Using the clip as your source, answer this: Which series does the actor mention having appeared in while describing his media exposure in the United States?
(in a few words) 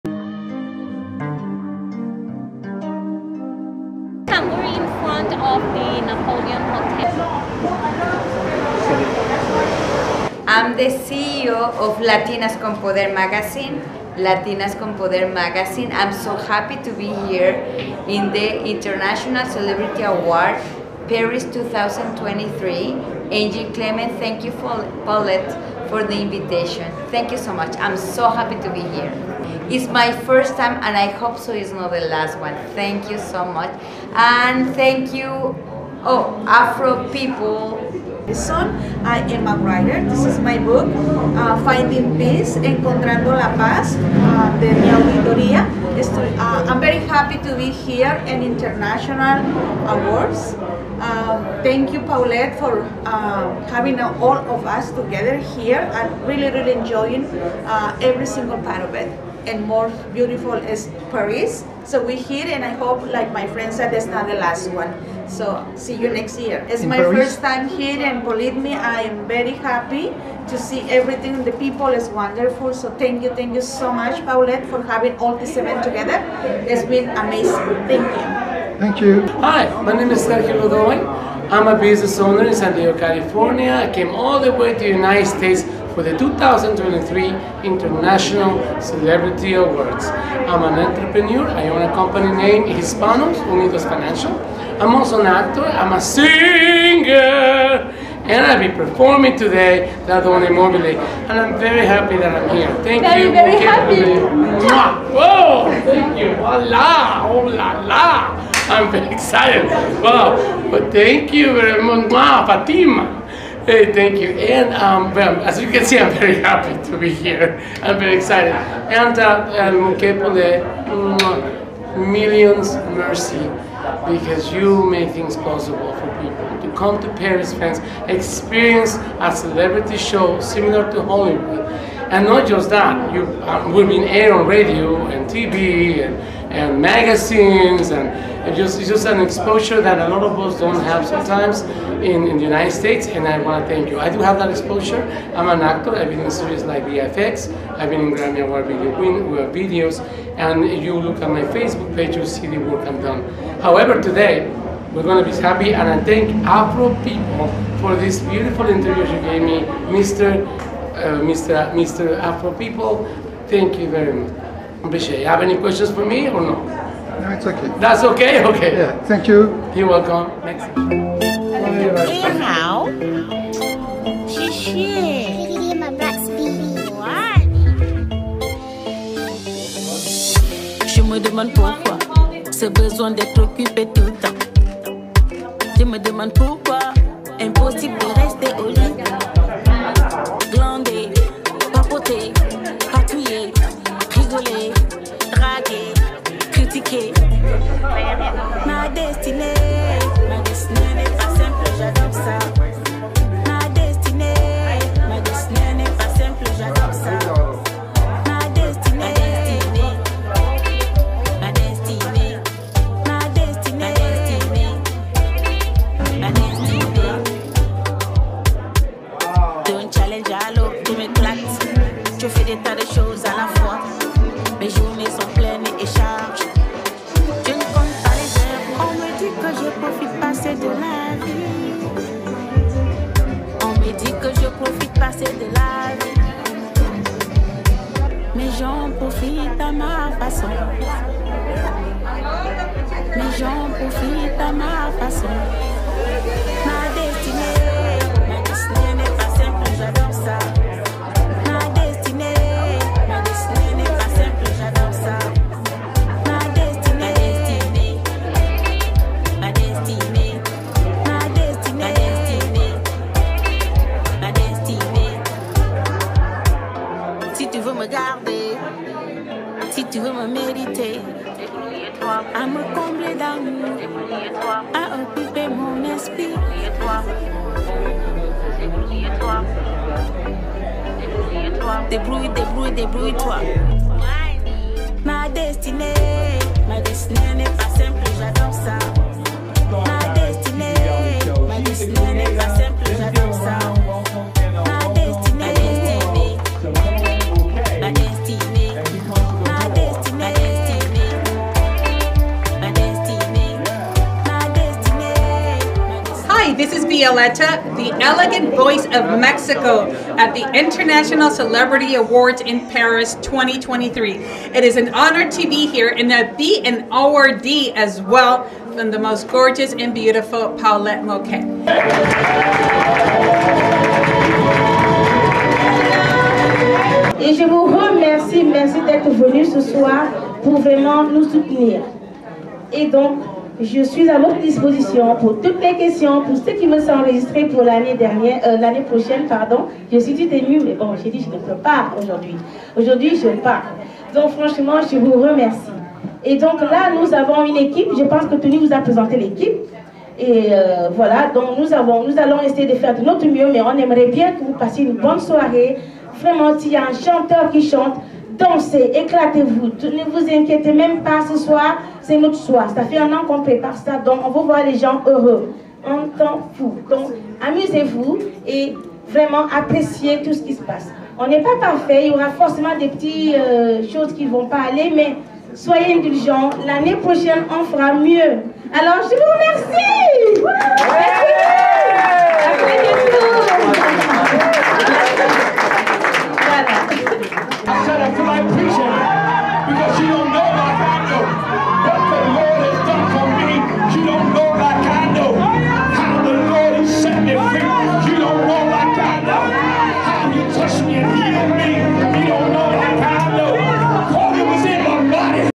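VFX.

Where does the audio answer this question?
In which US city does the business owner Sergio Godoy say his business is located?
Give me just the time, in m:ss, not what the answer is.
1:22.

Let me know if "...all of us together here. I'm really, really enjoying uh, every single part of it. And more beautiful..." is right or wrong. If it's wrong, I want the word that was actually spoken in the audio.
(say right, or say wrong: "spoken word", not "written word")
right.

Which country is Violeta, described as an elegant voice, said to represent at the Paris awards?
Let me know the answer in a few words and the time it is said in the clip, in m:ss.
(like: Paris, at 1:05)
Mexico, at 5:09.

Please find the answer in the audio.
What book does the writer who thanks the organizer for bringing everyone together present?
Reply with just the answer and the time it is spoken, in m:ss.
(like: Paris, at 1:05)
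Finding Peace, at 0:41.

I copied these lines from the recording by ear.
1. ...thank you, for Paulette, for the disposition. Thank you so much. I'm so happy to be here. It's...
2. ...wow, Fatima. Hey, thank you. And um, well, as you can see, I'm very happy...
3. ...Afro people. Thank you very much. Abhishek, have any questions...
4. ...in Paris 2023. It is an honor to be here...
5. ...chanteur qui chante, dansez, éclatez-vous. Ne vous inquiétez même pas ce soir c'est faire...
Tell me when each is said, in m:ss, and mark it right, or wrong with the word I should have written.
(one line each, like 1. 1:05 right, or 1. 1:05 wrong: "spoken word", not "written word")
1. 0:24 wrong: "invitation", not "disposition"
2. 1:52 right
3. 2:42 right
4. 5:12 right
5. 5:56 wrong: "notre", not "faire".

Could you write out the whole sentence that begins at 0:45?
Uh, I'm very happy to be here and international awards.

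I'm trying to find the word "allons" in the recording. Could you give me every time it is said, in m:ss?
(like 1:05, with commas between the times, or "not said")
5:52.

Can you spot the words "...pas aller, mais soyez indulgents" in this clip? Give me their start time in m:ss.
6:14.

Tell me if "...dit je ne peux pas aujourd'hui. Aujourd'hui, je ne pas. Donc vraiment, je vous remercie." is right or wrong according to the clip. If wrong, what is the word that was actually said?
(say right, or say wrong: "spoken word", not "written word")
wrong: "franchement", not "vraiment".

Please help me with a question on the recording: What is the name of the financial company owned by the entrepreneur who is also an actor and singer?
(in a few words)
Hispanos Unidos Financial.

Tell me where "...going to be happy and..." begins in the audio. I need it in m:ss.
2:35.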